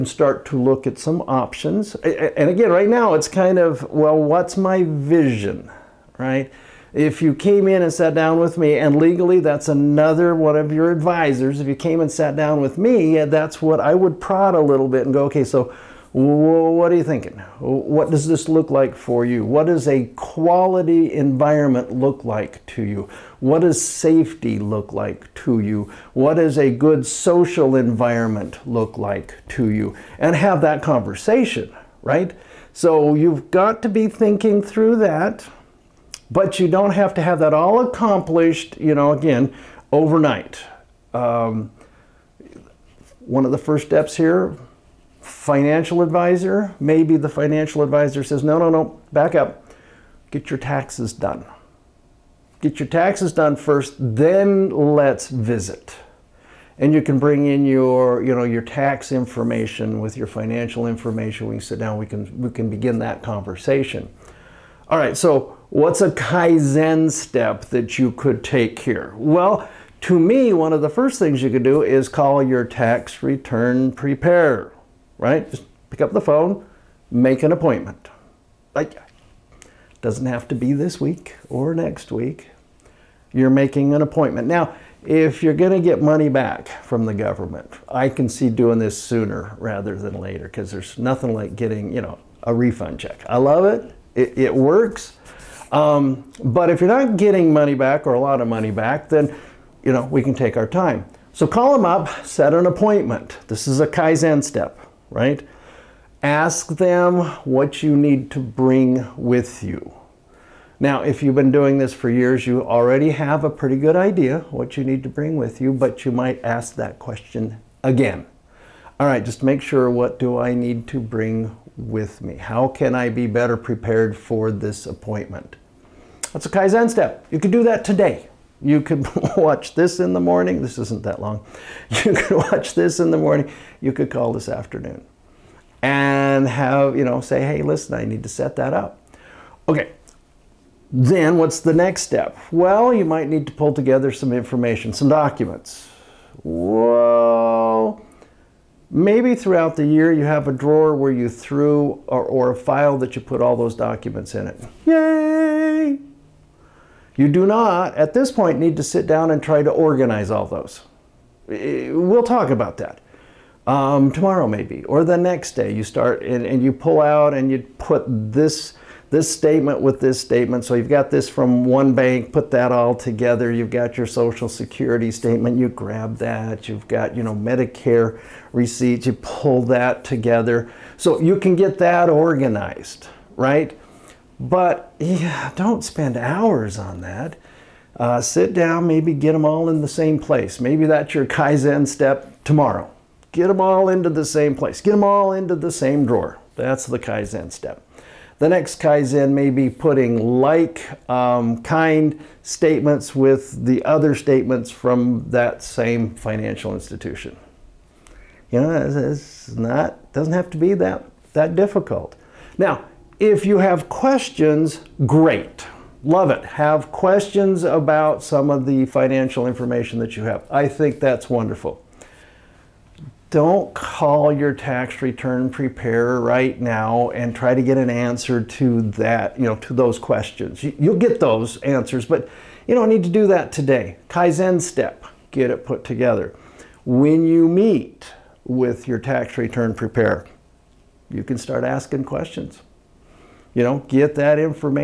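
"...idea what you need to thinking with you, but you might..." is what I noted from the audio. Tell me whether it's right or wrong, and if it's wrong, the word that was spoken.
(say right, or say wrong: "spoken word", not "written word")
wrong: "bring", not "thinking".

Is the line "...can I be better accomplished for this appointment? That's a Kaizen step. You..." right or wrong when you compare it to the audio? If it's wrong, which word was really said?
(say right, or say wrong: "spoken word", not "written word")
wrong: "prepared", not "accomplished".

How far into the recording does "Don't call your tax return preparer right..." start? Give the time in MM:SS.
03:43.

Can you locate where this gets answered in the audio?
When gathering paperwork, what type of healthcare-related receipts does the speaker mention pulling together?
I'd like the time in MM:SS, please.
02:57.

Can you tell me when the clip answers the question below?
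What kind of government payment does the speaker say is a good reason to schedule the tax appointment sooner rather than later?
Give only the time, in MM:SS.
01:32.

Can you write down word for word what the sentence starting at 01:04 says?
All right, so What's a Kaizen step that you could take here?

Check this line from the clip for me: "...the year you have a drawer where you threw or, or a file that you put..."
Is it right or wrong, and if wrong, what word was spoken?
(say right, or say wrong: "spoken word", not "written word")
right.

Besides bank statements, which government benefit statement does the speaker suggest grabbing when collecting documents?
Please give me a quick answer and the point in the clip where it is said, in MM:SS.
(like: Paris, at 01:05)
Social security statement, at 02:54.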